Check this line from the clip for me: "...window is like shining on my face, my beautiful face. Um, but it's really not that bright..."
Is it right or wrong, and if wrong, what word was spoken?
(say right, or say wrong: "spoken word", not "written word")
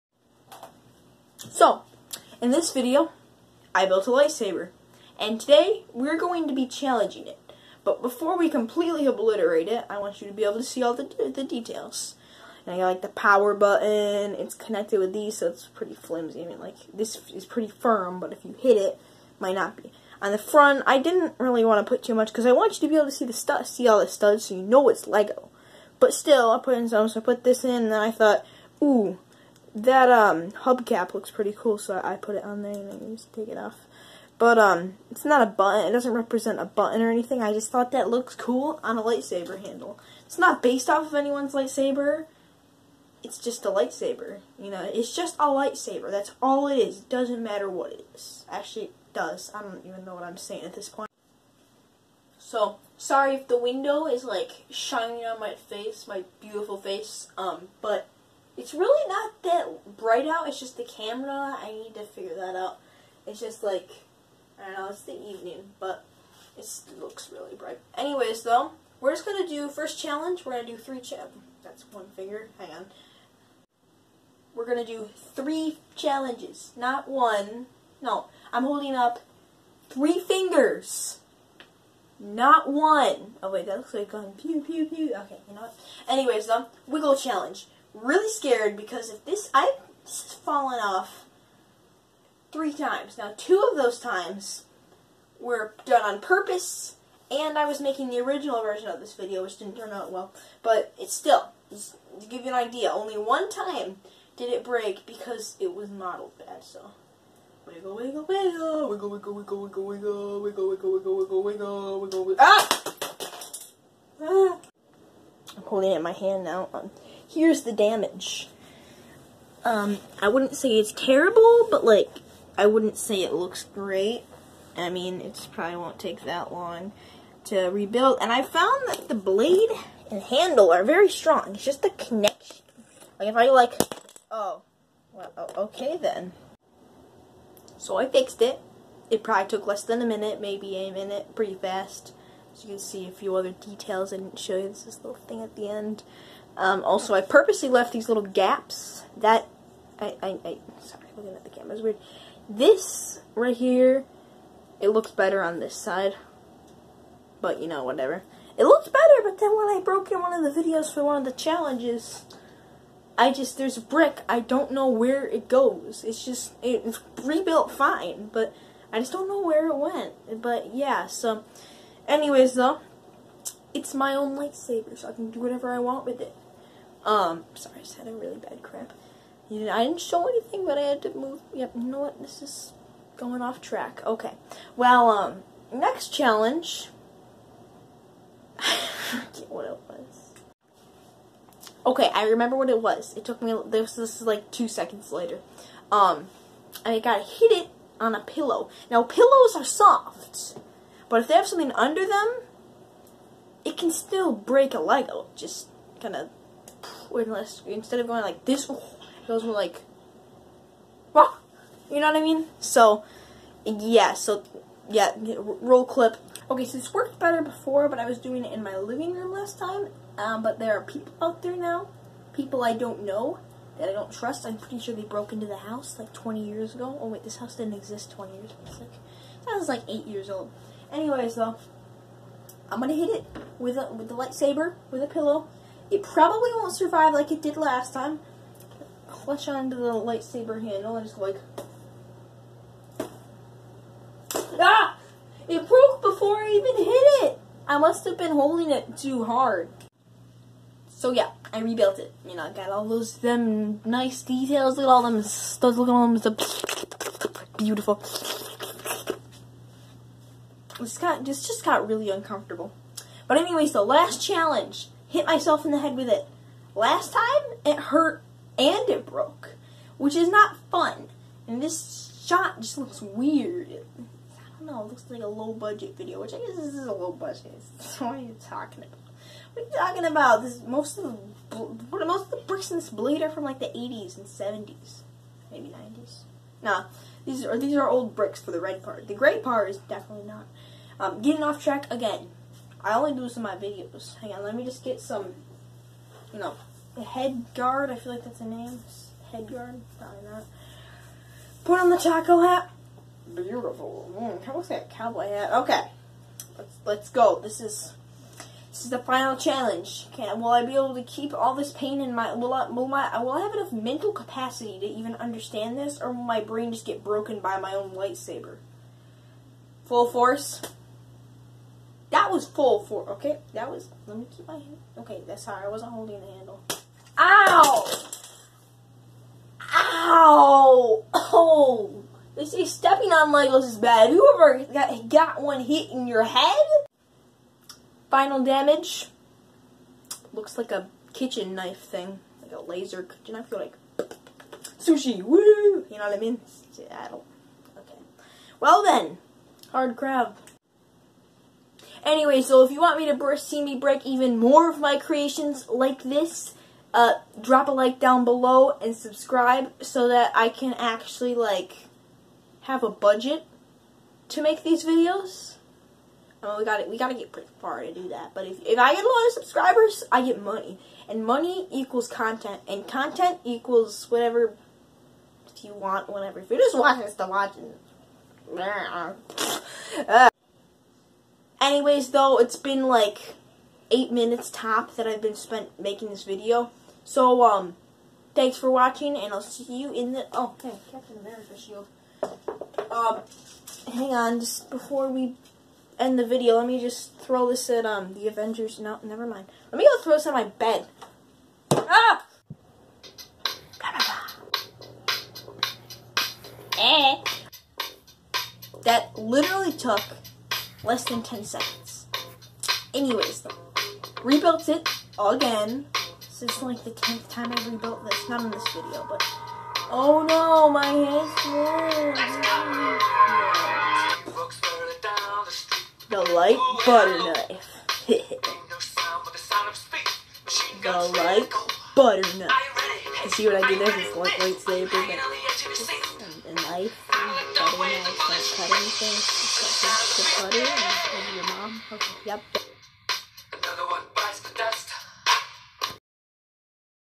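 right.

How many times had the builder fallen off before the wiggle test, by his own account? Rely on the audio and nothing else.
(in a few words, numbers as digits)
3.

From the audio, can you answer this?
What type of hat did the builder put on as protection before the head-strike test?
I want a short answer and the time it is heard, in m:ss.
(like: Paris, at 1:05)
taco hat, at 5:01.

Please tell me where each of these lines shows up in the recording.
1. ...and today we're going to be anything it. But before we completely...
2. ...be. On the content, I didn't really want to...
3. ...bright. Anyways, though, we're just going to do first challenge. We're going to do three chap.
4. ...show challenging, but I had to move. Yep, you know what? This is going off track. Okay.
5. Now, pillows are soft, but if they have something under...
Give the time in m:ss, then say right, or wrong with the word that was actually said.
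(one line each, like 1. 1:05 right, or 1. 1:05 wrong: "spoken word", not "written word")
1. 0:05 wrong: "challenging", not "anything"
2. 0:19 wrong: "front", not "content"
3. 1:07 right
4. 3:00 wrong: "anything", not "challenging"
5. 3:18 right.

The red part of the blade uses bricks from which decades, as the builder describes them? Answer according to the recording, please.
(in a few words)
80s and 70s.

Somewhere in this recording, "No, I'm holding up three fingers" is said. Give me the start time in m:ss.
1:18.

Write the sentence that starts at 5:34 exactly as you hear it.
Whoever got, got one hit in your head?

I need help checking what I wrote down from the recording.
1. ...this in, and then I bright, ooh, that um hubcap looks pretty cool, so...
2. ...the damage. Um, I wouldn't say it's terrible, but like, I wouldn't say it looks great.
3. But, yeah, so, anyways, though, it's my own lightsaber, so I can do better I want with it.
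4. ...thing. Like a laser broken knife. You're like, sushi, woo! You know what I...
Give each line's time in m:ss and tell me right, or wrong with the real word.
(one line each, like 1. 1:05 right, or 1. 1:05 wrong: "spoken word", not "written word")
1. 0:27 wrong: "thought", not "bright"
2. 1:57 right
3. 2:50 wrong: "whatever", not "better"
4. 5:41 wrong: "kitchen", not "broken".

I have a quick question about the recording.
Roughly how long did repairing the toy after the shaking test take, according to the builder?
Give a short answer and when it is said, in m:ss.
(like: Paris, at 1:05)
less than a minute, at 2:19.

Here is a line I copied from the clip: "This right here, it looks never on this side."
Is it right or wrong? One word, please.
wrong.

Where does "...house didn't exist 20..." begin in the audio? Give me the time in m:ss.
3:47.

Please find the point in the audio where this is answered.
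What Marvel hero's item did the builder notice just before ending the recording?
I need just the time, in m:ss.
6:30.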